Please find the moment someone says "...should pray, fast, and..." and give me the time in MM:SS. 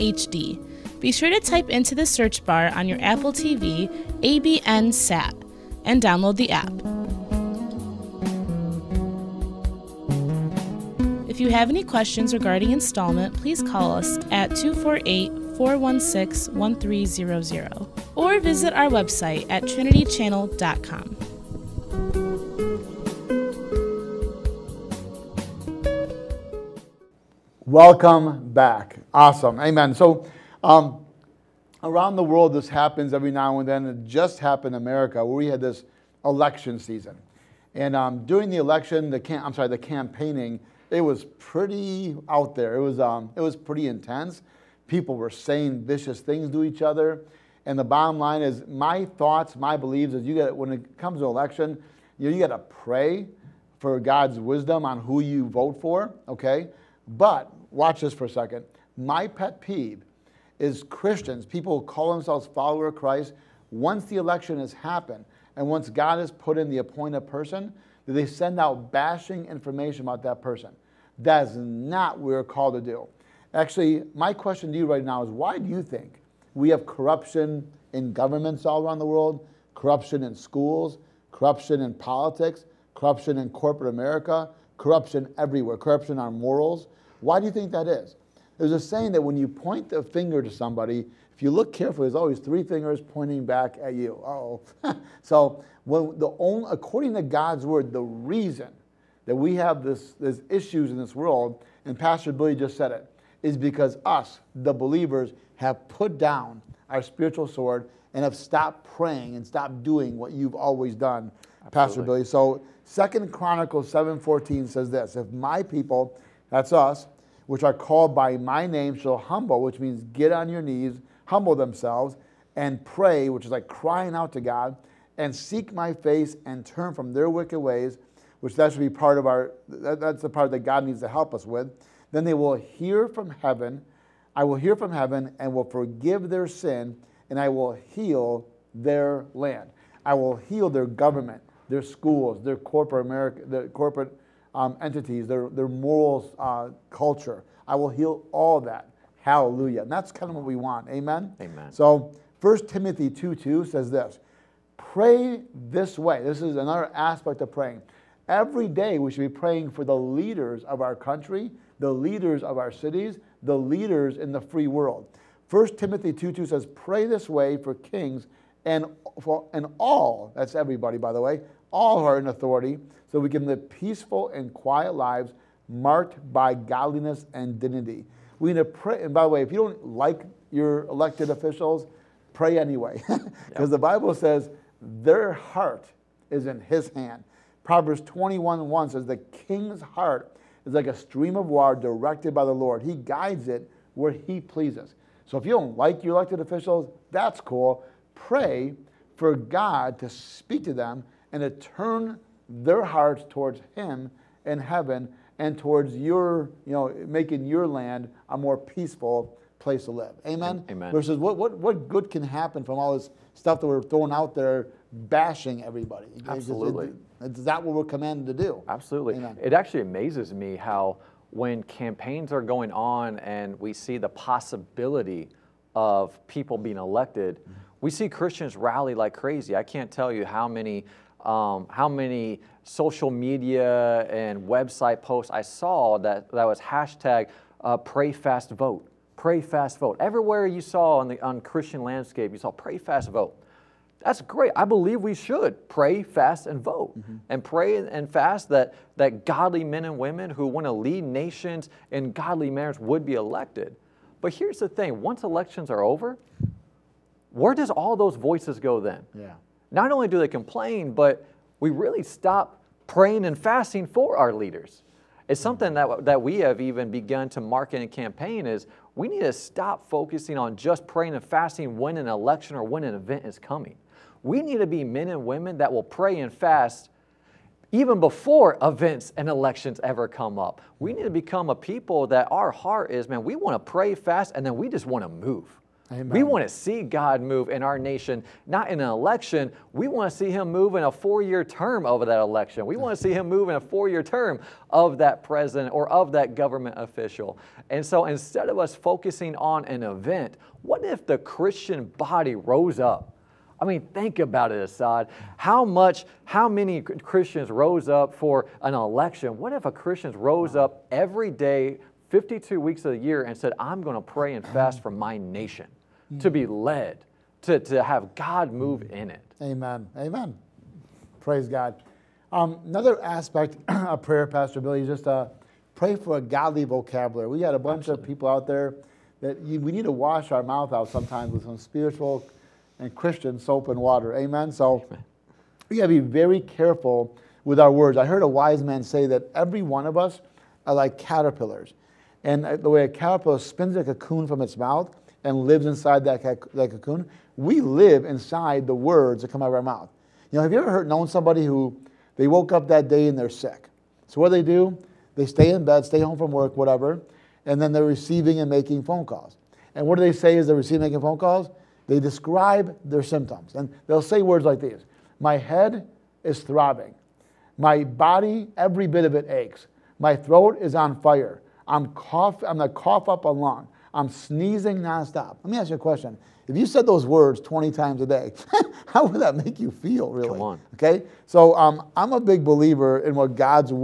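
04:05.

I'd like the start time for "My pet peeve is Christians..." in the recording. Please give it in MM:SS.
00:58.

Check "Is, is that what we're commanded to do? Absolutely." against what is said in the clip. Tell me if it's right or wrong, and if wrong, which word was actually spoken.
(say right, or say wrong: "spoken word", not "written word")
right.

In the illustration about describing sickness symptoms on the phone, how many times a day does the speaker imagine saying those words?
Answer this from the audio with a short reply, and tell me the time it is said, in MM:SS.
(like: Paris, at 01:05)
20, at 06:17.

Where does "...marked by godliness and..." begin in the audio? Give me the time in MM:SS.
02:55.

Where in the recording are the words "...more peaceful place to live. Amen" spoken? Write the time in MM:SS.
03:28.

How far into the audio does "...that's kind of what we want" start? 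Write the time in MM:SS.
02:29.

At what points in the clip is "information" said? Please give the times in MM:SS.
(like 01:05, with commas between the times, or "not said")
01:09.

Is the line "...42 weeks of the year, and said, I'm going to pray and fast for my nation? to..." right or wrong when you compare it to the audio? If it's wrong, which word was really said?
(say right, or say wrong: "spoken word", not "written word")
wrong: "52", not "42".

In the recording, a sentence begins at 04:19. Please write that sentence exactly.
Yeah not only do they complain, but we really stop praying and fasting for our leaders.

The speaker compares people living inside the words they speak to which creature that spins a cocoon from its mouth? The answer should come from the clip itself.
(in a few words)
caterpillars.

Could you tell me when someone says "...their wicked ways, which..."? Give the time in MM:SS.
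02:07.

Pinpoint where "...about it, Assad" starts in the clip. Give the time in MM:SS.
05:04.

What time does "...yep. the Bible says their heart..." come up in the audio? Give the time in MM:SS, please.
03:03.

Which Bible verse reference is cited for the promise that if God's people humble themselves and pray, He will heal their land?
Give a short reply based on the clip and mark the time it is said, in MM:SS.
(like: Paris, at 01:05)
Second Chronicles 7:14, at 01:52.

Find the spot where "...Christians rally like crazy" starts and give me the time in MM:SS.
03:48.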